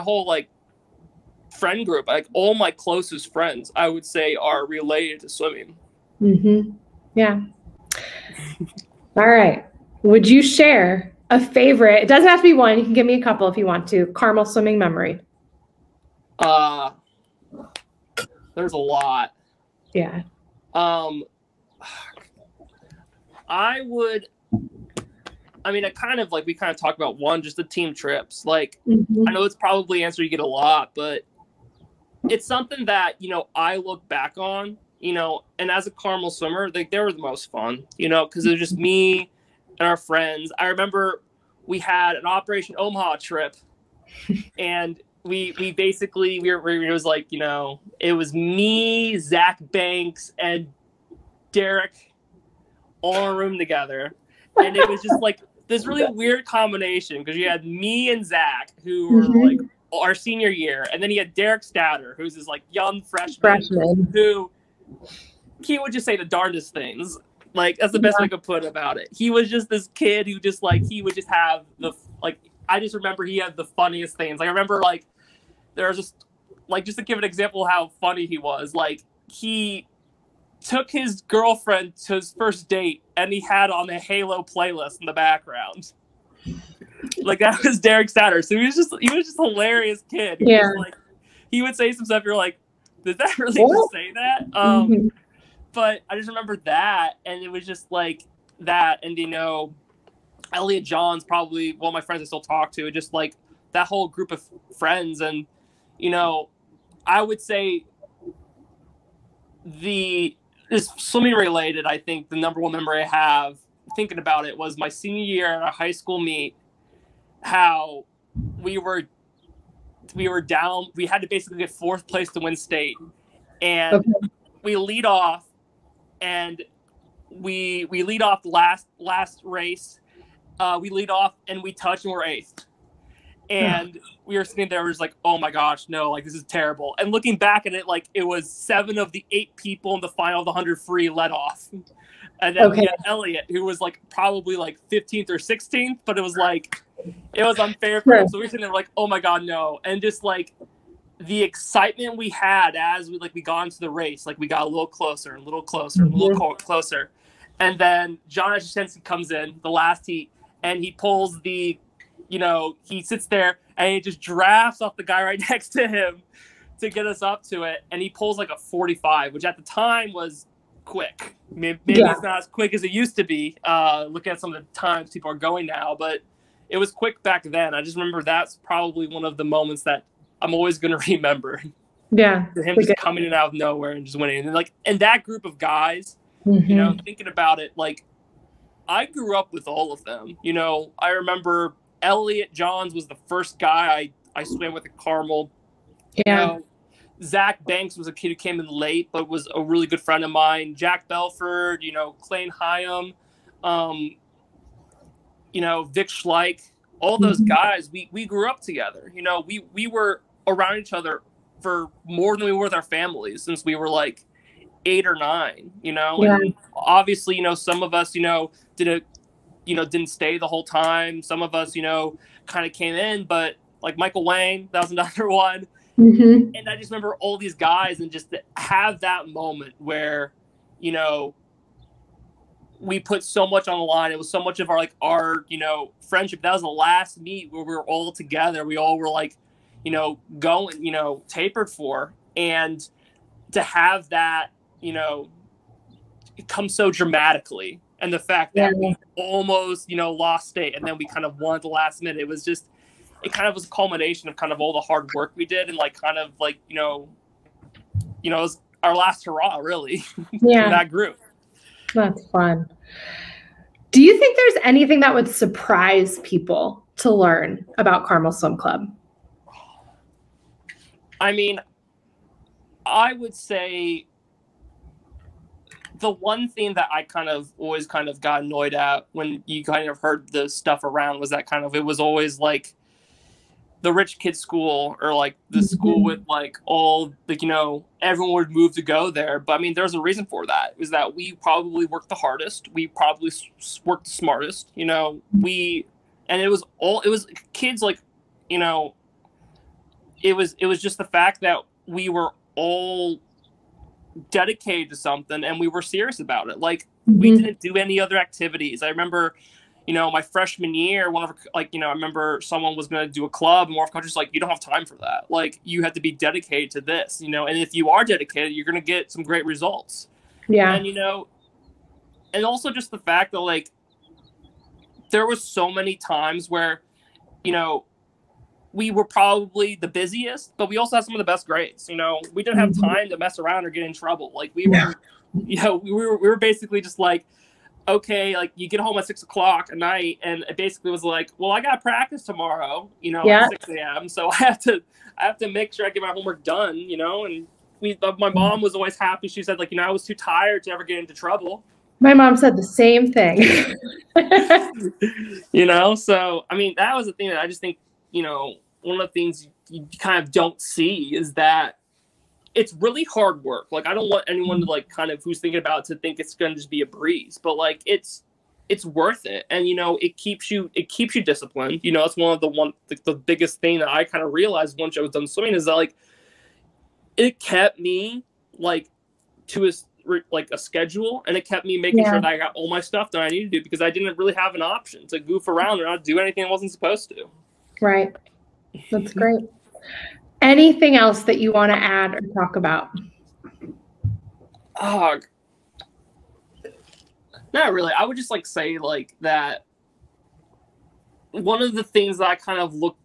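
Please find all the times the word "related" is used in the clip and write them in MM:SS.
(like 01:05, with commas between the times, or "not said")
00:04, 01:51.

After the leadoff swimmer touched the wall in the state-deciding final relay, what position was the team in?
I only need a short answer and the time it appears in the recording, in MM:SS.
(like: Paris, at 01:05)
eighth, at 02:12.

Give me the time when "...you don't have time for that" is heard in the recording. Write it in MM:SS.
05:14.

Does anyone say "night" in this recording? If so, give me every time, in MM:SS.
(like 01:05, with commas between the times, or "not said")
05:39.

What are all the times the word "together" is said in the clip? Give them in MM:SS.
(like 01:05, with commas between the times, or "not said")
00:53, 03:28, 03:58.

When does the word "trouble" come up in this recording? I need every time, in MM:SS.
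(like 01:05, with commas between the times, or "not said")
05:33, 05:51.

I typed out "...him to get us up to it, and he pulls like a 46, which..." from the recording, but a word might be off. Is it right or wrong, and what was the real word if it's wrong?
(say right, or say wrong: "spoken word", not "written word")
wrong: "45", not "46".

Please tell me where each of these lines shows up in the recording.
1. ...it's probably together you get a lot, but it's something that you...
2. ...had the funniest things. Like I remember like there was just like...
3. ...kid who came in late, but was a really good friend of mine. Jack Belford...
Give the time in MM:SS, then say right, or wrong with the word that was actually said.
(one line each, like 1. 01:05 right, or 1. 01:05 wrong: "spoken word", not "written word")
1. 00:29 wrong: "answer", not "together"
2. 01:13 right
3. 03:18 right.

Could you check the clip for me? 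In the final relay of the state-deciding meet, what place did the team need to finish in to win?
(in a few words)
fourth place.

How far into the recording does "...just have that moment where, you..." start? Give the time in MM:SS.
03:48.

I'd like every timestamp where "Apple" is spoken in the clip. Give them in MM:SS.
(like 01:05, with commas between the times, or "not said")
not said.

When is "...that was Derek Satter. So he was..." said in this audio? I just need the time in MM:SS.
01:27.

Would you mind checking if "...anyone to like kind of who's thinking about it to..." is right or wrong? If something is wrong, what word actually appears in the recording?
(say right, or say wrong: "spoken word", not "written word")
right.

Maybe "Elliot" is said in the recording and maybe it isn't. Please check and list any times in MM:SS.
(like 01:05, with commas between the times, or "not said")
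01:40, 02:23, 03:12.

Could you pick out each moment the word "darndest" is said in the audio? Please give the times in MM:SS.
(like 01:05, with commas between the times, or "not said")
01:06.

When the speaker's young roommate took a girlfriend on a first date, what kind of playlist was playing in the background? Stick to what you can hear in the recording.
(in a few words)
Halo.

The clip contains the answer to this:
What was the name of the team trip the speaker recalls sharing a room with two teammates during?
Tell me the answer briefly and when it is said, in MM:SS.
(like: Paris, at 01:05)
Operation Omaha, at 00:42.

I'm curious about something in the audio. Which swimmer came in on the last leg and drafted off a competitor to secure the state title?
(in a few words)
John Ashensky.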